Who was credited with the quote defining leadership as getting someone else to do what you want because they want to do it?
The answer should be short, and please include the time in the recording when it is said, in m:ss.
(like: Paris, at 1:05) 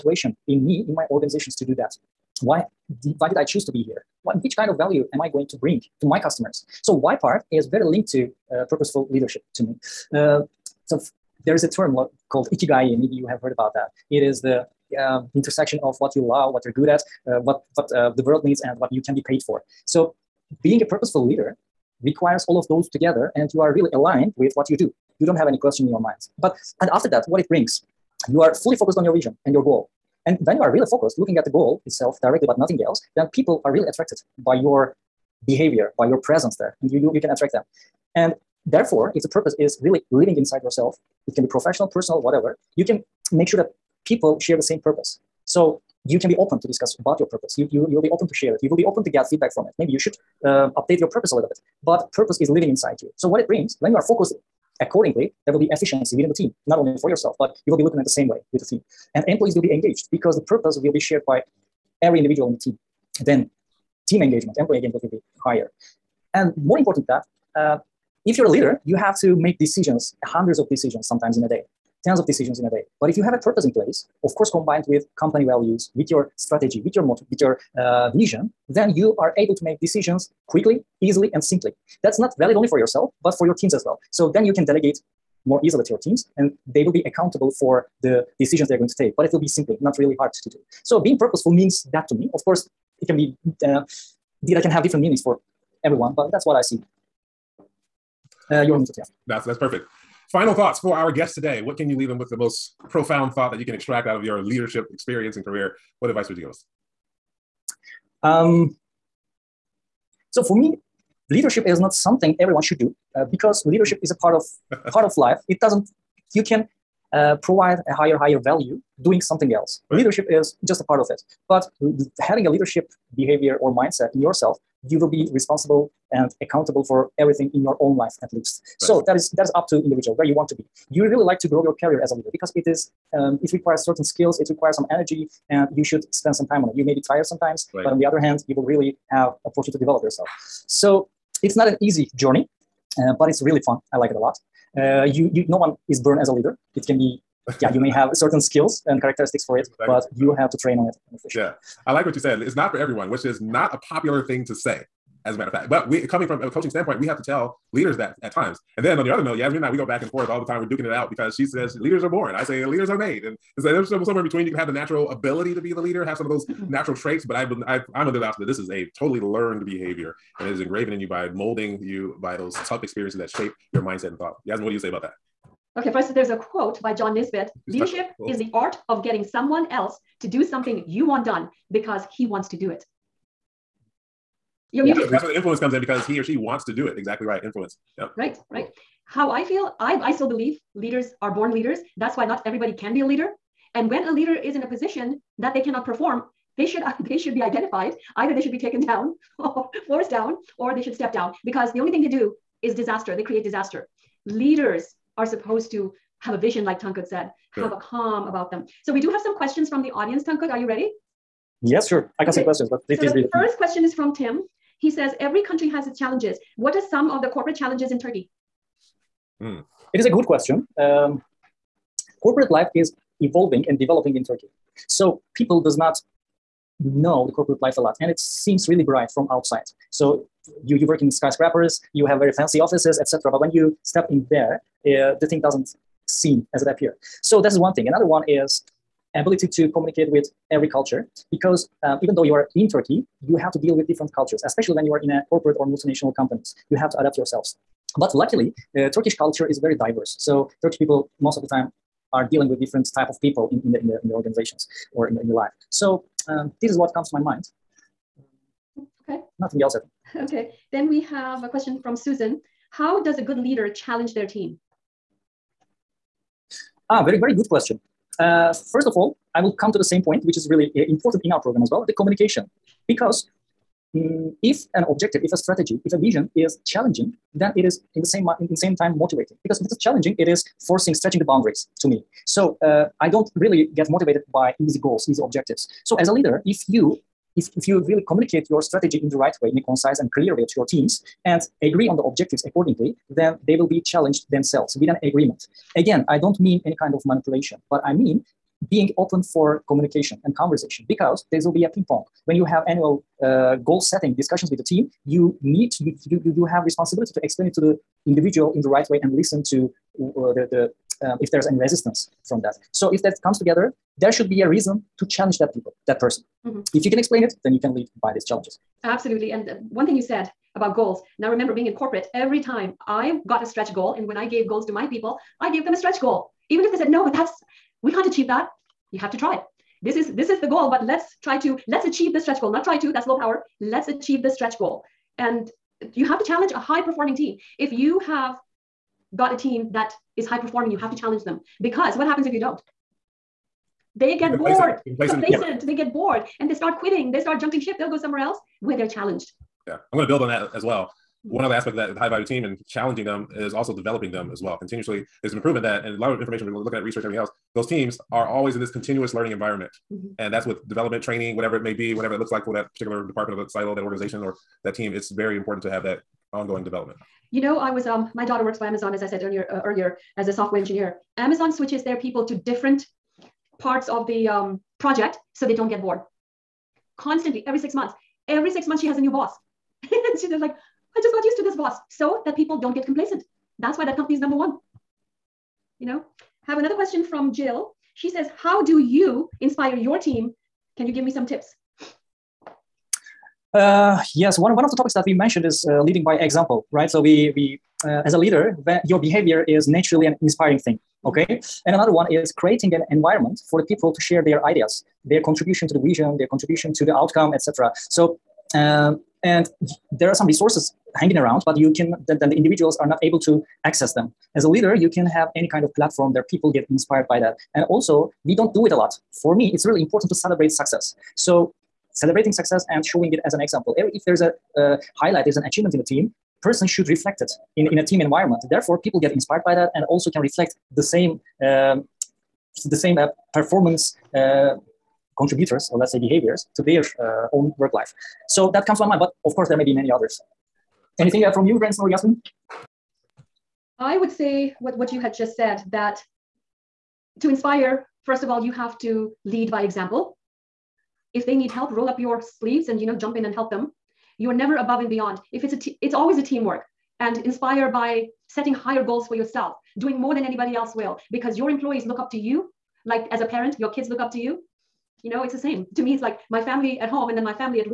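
John Nisbet, at 2:56.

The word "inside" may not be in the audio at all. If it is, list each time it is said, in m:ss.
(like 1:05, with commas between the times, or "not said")
0:40, 0:52.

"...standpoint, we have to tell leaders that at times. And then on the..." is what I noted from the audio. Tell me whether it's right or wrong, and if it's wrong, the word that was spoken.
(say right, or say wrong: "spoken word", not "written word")
right.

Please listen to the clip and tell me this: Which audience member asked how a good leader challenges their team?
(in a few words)
Susan.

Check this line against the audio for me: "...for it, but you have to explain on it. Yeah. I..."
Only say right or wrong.
wrong.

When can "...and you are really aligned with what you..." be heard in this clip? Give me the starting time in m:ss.
0:23.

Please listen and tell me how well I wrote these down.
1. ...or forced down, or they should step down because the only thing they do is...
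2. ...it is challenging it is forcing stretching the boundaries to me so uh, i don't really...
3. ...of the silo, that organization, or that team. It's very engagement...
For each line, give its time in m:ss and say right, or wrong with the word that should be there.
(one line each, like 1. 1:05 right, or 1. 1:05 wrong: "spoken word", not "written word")
1. 3:19 right
2. 4:39 right
3. 6:03 wrong: "important", not "engagement".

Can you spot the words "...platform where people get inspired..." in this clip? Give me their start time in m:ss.
6:55.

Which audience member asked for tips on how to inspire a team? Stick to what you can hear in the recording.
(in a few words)
Jill.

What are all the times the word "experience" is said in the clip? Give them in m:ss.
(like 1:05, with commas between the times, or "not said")
1:44, 2:52.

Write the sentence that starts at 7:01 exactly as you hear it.
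So, celebrating success and showing it as an example.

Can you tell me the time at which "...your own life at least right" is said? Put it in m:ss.
2:07.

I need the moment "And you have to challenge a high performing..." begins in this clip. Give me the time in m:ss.
5:35.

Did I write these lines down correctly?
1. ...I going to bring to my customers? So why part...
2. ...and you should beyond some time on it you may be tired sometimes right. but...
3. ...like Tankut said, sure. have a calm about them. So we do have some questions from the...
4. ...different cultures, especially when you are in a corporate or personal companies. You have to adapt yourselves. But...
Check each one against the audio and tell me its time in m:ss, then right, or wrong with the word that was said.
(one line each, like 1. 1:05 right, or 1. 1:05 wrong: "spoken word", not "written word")
1. 0:05 right
2. 2:15 wrong: "spend", not "beyond"
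3. 3:26 right
4. 4:03 wrong: "multinational", not "personal".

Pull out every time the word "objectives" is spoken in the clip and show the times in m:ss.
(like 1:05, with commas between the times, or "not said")
4:34, 4:45, 4:52.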